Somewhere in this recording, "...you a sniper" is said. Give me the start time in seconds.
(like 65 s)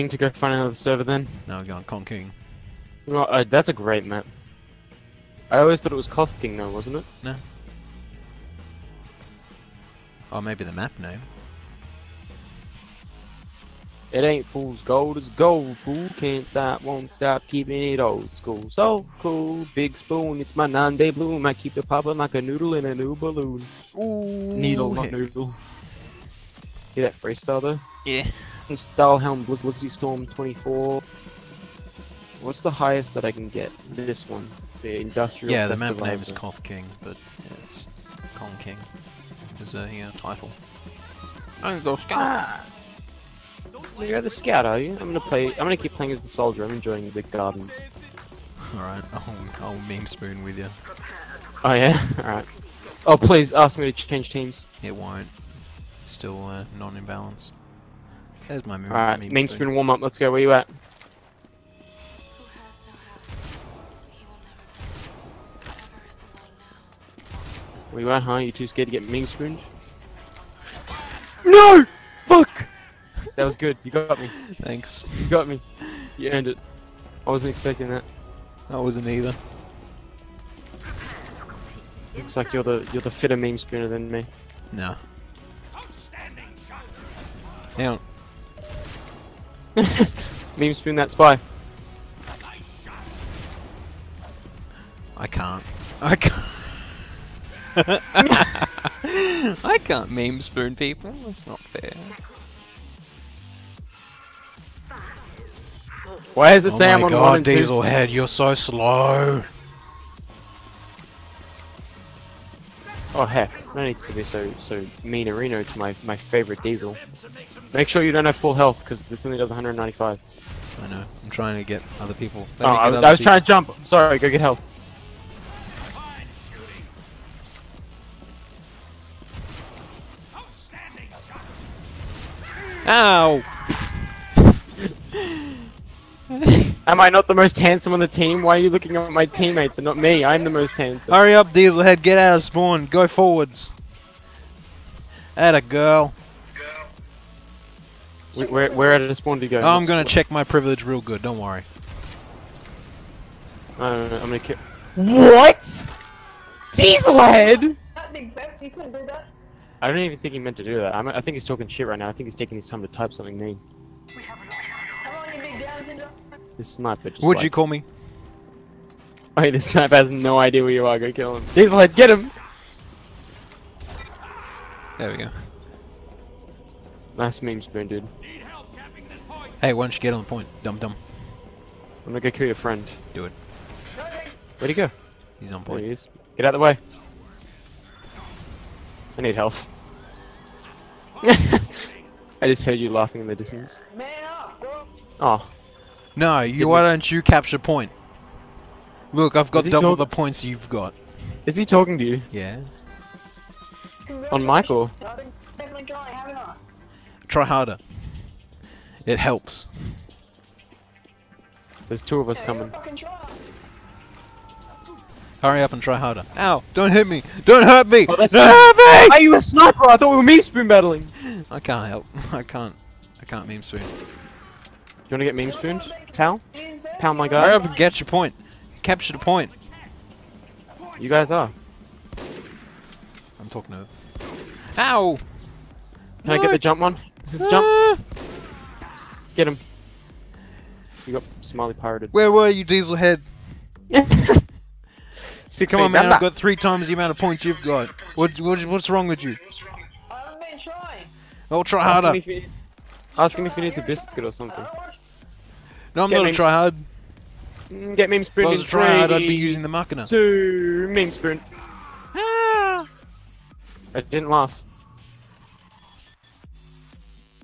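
219 s.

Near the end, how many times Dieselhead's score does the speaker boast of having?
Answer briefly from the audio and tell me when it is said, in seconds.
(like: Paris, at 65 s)
3 times, at 246 s.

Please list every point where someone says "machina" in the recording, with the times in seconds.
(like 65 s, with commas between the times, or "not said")
259 s.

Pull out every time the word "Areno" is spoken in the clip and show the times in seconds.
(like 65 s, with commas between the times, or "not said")
115 s.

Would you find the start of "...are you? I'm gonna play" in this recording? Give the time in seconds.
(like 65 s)
44 s.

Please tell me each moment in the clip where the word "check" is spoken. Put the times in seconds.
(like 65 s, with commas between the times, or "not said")
150 s.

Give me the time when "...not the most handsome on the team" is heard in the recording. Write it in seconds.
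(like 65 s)
137 s.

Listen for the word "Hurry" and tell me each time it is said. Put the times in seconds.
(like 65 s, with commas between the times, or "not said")
141 s, 215 s, 227 s.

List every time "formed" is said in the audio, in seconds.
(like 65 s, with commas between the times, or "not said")
not said.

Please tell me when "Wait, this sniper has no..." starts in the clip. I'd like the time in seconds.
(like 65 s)
169 s.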